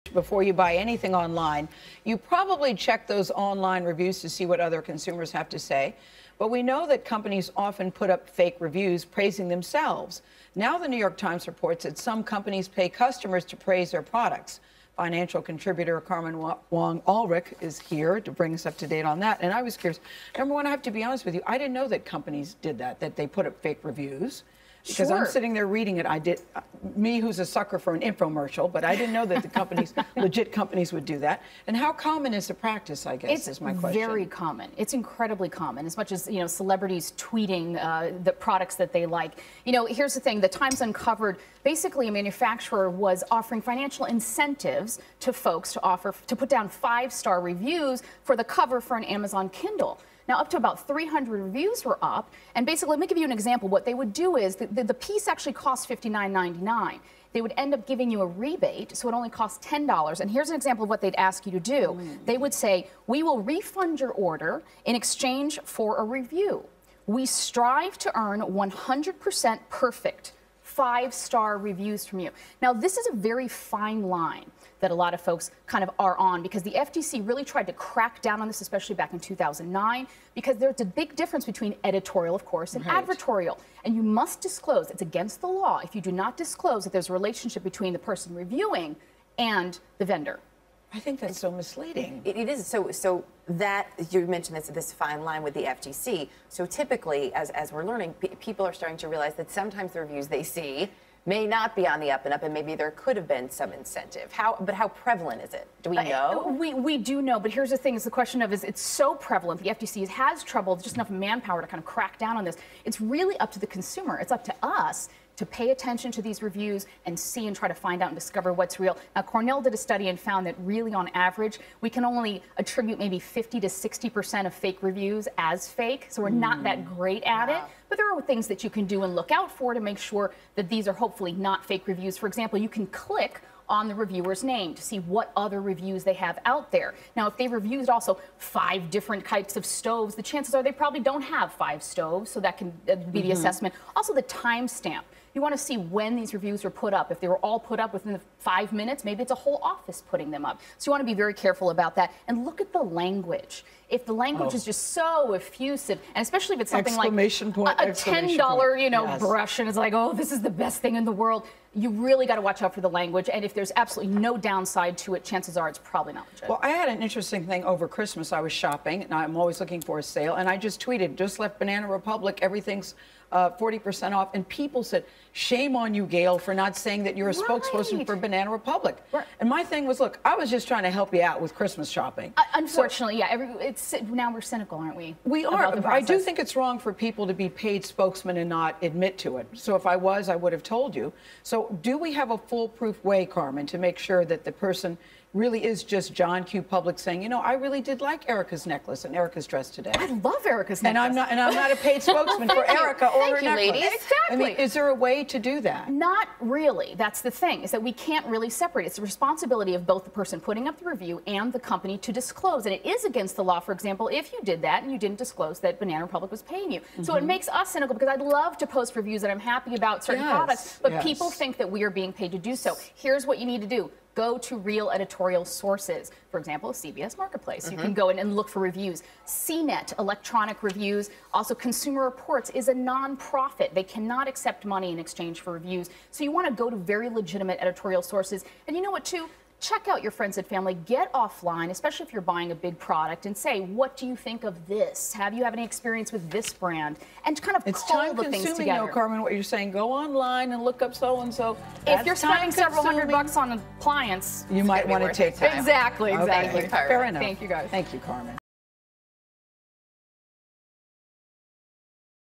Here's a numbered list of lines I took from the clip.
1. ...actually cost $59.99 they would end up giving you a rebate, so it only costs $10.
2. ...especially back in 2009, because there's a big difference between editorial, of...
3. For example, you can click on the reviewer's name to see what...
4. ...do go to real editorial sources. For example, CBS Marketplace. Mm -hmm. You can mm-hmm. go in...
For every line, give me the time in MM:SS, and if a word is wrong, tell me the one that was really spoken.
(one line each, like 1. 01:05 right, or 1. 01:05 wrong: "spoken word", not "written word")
1. 00:55 right
2. 01:18 right
3. 02:12 right
4. 03:43 right.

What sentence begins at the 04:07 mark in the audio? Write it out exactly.
And kind of it's time consuming, No, Carmen, what you're saying.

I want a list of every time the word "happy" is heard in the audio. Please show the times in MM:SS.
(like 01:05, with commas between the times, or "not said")
03:39.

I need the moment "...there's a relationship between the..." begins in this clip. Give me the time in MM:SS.
01:26.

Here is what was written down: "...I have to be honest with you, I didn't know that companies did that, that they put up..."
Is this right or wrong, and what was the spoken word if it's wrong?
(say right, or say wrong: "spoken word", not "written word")
right.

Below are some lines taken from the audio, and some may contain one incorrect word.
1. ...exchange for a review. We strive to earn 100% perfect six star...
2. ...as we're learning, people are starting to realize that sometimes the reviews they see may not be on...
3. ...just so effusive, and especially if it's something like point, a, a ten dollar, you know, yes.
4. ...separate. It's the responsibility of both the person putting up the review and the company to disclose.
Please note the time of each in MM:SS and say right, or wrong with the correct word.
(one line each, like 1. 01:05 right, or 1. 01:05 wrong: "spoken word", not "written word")
1. 01:04 wrong: "five", not "six"
2. 01:37 right
3. 02:34 right
4. 03:28 right.